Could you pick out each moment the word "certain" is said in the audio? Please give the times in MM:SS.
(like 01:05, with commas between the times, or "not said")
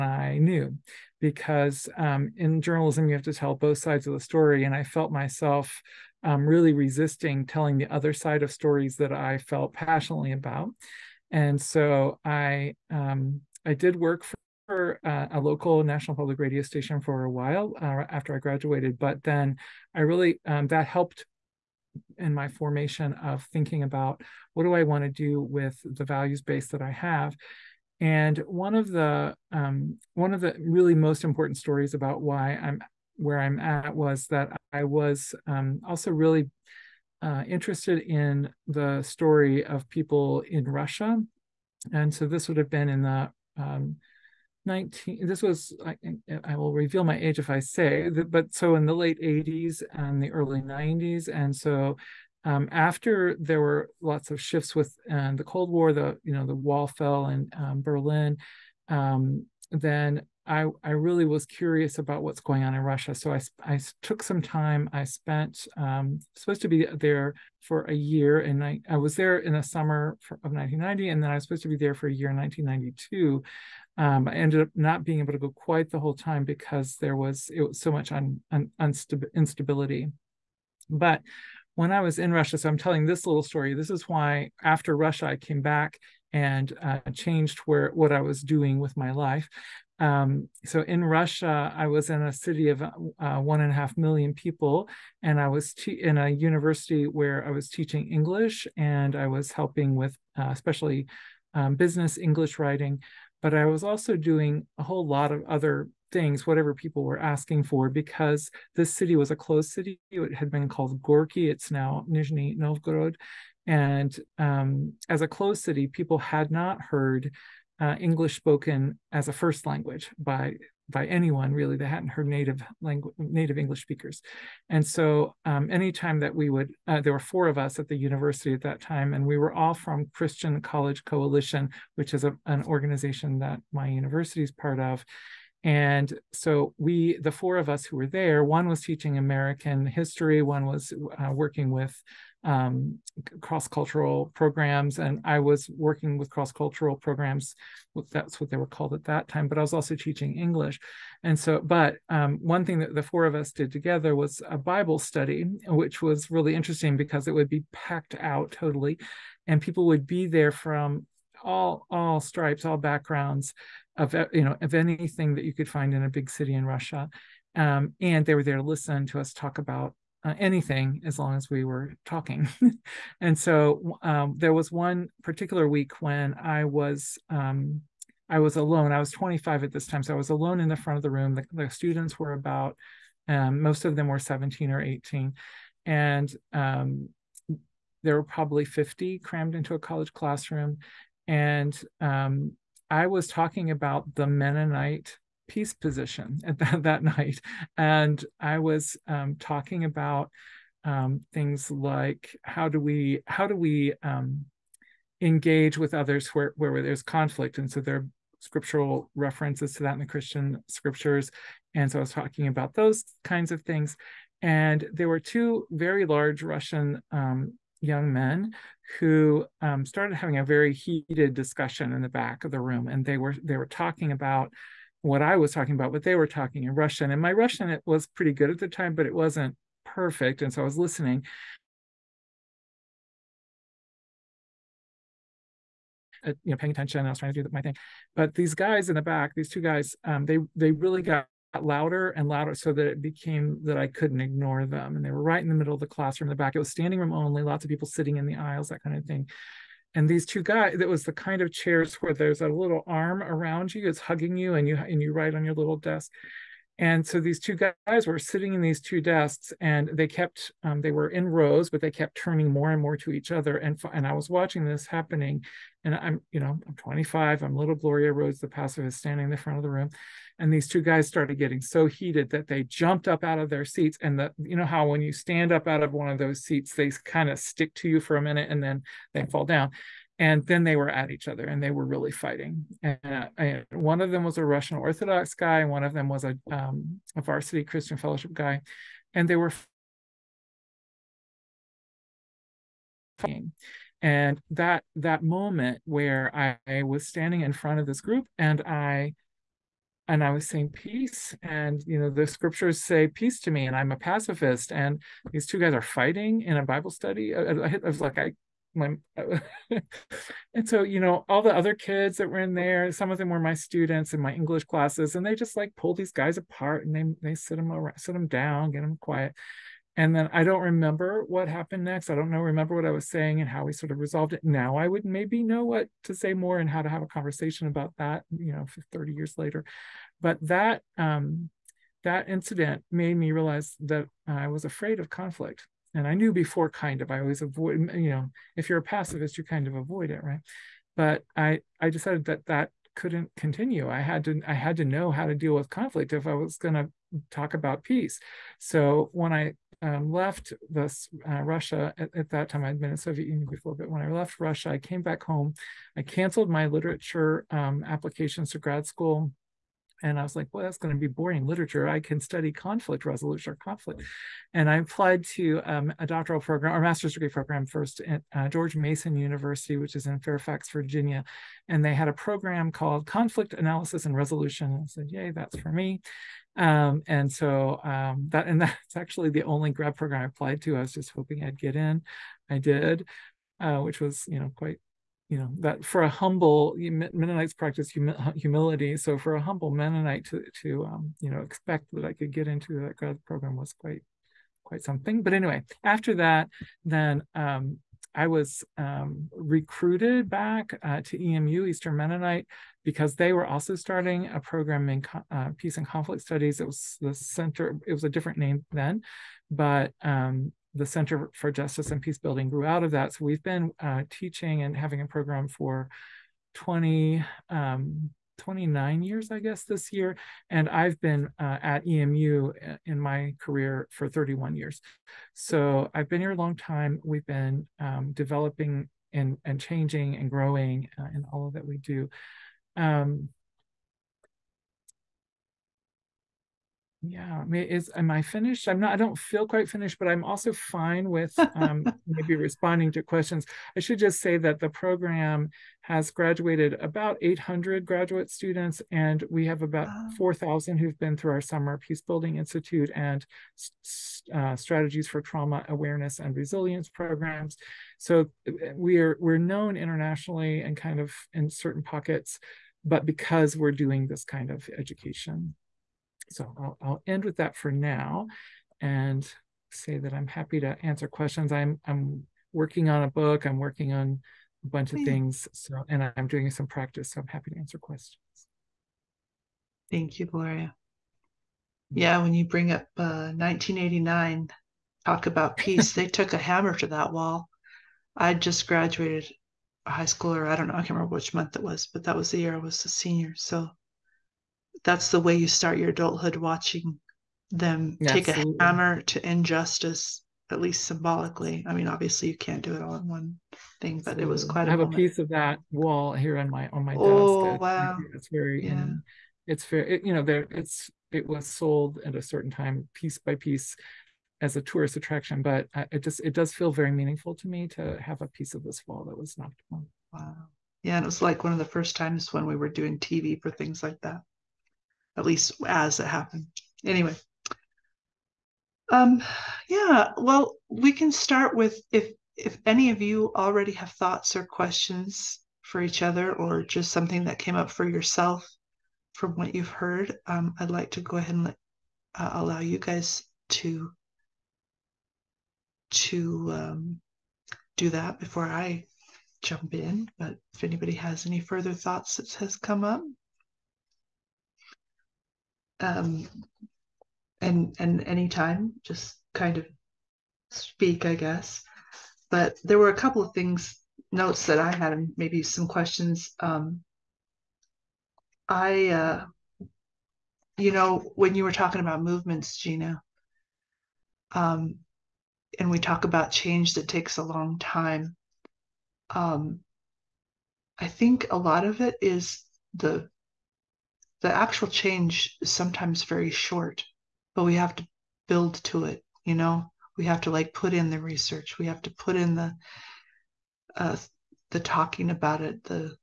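07:41, 08:32.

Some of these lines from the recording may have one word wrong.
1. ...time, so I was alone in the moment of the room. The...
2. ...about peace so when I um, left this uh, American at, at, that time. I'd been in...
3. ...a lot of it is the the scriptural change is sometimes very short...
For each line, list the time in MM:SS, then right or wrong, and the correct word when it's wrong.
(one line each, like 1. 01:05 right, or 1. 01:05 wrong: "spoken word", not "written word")
1. 02:59 wrong: "front", not "moment"
2. 05:47 wrong: "Russia", not "American"
3. 09:41 wrong: "actual", not "scriptural".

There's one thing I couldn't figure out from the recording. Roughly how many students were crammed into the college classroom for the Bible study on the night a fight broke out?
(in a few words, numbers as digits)
50.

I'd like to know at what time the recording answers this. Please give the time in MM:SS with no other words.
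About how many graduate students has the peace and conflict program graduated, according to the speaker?
07:27.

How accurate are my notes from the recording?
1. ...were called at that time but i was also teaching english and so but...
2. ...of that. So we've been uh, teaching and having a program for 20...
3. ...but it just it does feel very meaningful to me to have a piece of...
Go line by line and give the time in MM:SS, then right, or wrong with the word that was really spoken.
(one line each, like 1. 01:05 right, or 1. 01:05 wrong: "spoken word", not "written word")
1. 02:28 right
2. 06:52 right
3. 08:35 right.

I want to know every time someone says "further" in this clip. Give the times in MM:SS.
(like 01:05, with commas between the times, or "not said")
09:11.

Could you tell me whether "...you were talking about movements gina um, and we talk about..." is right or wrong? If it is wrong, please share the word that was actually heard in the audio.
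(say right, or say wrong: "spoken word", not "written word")
right.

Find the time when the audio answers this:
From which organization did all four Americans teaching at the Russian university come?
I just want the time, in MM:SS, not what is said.
02:10.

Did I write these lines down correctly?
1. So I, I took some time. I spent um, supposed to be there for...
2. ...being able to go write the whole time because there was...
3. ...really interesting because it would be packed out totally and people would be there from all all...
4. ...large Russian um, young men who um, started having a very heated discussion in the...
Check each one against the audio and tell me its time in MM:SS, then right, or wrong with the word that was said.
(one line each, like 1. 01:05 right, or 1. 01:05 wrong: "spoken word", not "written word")
1. 01:03 right
2. 01:15 wrong: "quite", not "write"
3. 02:36 right
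4. 03:36 right.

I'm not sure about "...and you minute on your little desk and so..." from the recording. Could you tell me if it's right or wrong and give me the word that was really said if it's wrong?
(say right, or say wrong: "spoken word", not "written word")
wrong: "write", not "minute".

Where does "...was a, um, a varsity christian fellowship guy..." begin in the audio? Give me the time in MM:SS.
04:46.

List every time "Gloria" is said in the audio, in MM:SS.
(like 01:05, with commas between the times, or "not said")
04:27, 08:00.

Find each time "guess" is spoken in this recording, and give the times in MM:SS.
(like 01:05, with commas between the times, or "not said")
06:59, 09:21.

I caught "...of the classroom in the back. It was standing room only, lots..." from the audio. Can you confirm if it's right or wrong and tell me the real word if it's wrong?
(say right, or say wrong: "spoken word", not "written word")
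right.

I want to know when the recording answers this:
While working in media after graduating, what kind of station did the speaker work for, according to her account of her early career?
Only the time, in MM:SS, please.
00:15.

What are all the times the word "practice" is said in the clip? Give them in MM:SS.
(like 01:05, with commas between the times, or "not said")
06:27, 07:56.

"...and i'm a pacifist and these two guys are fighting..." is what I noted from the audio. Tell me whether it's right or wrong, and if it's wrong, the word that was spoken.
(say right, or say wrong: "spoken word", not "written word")
right.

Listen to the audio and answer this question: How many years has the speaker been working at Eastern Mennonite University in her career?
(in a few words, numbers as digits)
31.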